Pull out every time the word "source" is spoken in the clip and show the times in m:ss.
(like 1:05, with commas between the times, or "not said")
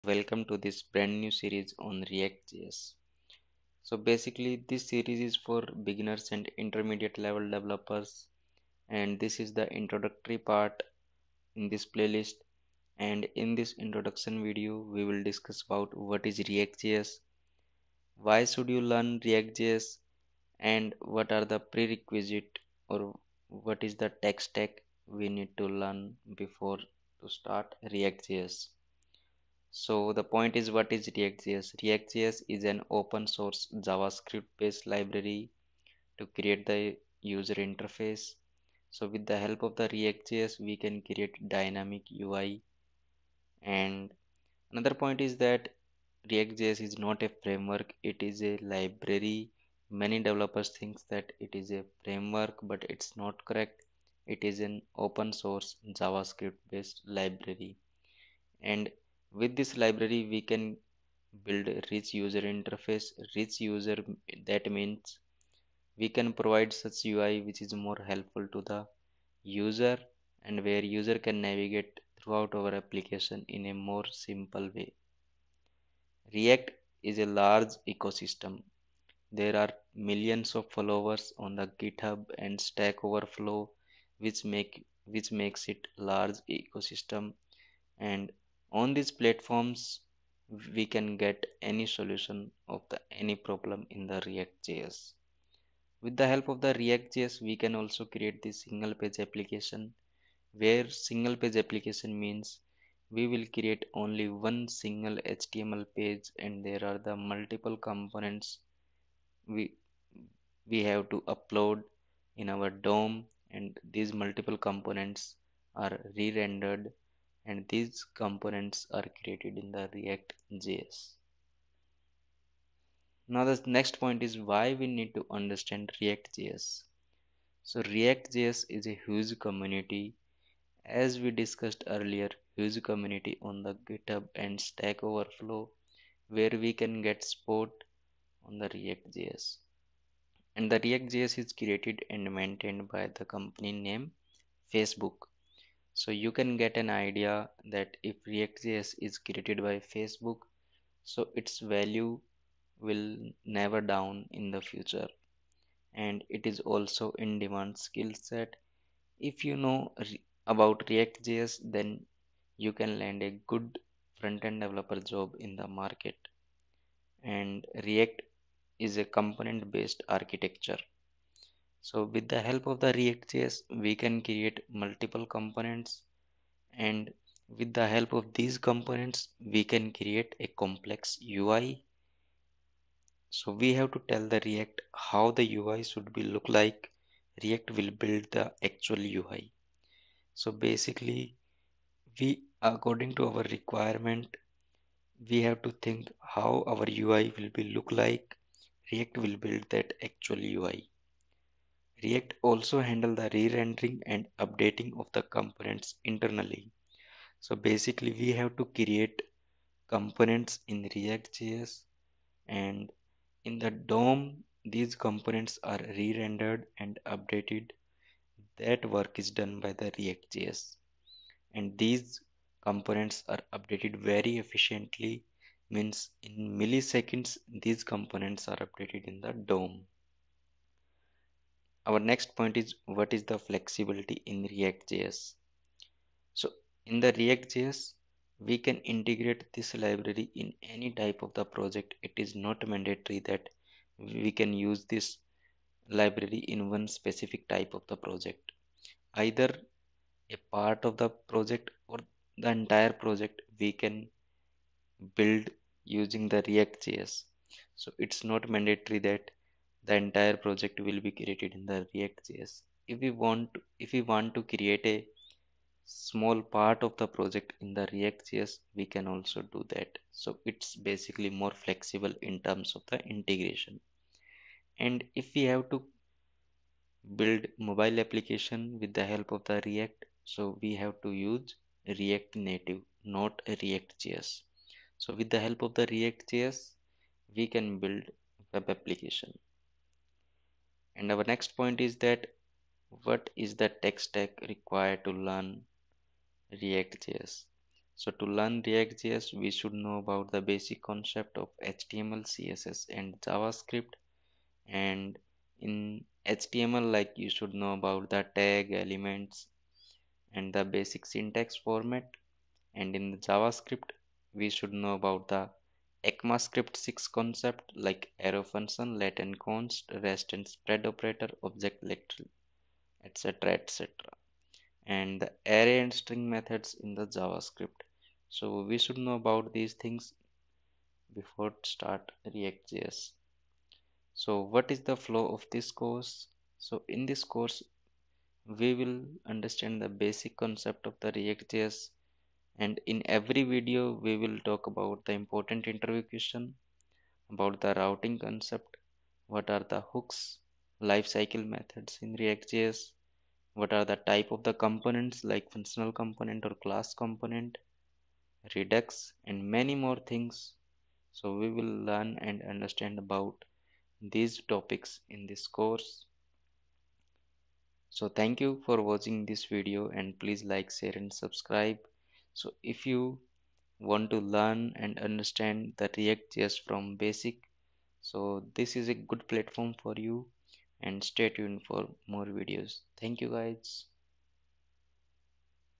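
0:33, 0:55.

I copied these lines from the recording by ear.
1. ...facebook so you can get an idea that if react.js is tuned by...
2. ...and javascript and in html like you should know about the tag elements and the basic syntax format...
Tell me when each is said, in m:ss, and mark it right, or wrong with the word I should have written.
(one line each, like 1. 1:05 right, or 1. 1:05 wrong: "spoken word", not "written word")
1. 2:24 wrong: "created", not "tuned"
2. 5:02 right.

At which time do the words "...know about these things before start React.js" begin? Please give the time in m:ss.
5:28.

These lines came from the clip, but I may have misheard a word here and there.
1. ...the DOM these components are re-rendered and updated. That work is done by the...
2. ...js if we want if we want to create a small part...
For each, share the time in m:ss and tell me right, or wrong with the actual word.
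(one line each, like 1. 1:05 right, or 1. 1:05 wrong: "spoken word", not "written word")
1. 3:33 right
2. 4:22 right.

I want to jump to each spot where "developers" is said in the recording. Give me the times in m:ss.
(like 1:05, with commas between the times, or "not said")
0:07, 0:50, 2:44.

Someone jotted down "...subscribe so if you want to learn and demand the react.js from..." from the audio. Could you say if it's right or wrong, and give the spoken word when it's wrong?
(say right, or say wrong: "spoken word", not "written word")
wrong: "understand", not "demand".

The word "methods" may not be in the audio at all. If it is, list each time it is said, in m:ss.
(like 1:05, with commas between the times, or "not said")
5:26, 5:51.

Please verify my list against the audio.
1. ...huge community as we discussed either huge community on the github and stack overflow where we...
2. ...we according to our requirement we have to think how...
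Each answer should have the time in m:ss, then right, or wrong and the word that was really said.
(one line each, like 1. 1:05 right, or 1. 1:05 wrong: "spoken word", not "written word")
1. 2:09 wrong: "earlier", not "either"
2. 3:12 right.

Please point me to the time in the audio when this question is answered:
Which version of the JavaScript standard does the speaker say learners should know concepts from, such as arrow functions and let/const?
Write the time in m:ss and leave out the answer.
5:16.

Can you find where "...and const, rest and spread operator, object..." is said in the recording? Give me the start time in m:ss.
5:19.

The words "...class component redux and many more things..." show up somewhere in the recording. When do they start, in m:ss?
5:56.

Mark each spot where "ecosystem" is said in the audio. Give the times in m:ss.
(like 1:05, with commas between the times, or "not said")
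1:17, 1:26.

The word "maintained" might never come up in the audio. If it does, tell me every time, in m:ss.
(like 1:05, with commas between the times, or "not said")
2:22.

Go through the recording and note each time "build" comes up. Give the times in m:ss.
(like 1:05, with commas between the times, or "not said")
1:01, 3:08, 3:19, 4:15, 4:37, 4:47.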